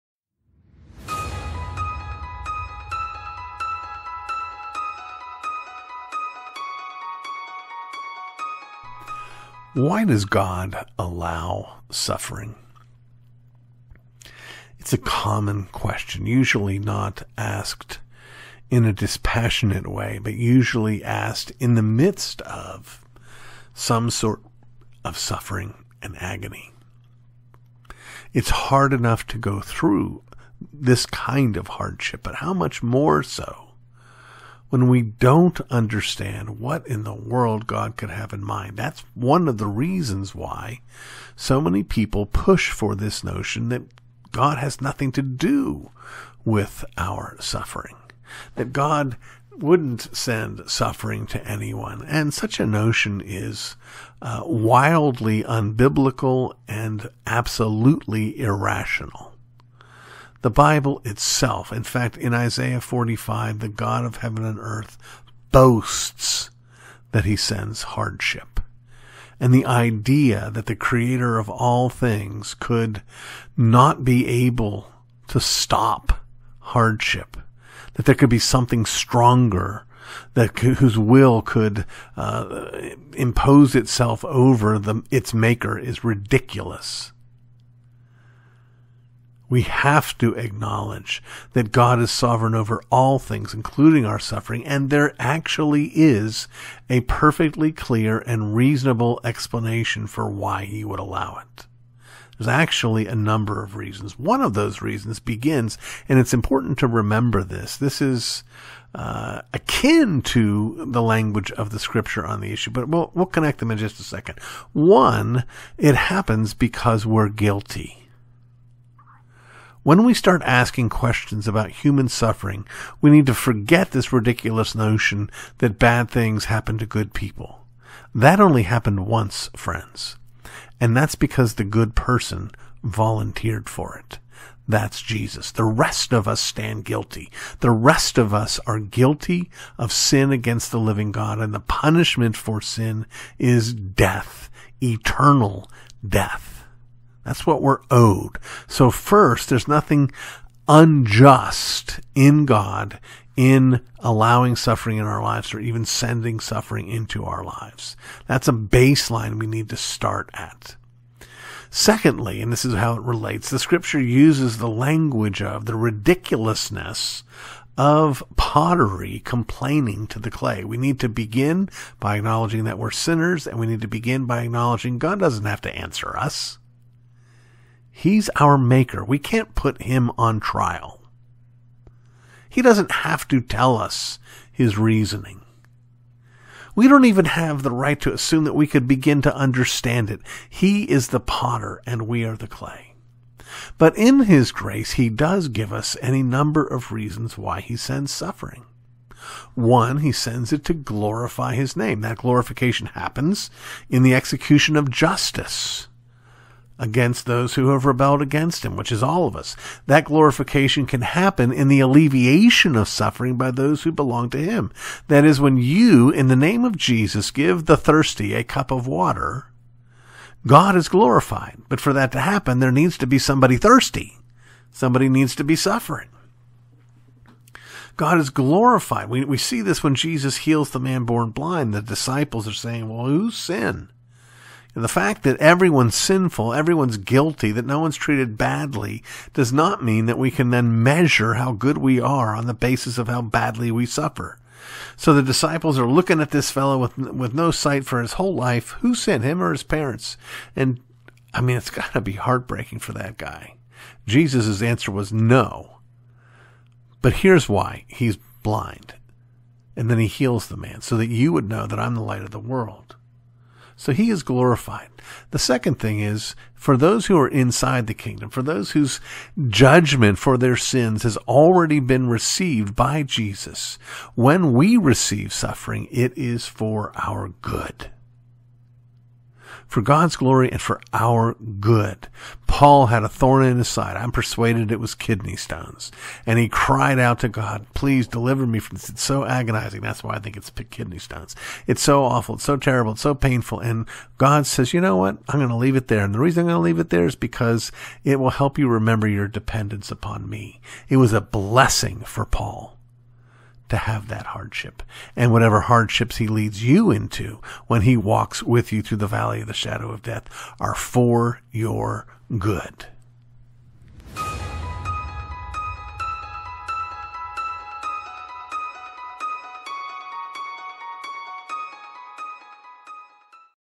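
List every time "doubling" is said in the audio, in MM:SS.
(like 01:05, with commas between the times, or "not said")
not said.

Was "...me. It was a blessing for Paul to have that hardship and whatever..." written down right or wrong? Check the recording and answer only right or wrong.
right.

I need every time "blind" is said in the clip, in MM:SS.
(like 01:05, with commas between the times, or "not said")
03:51, 04:18.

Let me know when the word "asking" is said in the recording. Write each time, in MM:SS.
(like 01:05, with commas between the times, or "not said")
02:00.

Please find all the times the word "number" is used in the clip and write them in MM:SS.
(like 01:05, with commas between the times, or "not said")
01:43, 03:16.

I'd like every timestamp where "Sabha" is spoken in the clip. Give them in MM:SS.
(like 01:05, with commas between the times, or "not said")
not said.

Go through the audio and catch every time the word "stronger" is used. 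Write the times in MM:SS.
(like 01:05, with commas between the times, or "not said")
01:18.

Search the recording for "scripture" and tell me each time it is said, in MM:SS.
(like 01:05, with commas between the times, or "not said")
01:51, 02:43.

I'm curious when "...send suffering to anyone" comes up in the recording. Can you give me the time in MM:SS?
00:50.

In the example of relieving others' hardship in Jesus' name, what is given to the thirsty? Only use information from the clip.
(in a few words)
a cup of water.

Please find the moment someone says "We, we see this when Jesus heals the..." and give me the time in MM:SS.
03:49.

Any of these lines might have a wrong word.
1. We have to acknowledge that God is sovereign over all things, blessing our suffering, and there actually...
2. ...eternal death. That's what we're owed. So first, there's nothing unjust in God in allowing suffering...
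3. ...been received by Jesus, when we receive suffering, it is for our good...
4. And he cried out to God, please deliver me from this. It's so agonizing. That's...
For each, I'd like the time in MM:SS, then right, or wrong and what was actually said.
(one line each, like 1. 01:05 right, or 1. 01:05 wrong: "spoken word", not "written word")
1. 01:29 wrong: "including", not "blessing"
2. 02:24 right
3. 04:31 right
4. 04:46 right.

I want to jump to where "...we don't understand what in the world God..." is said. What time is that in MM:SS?
00:34.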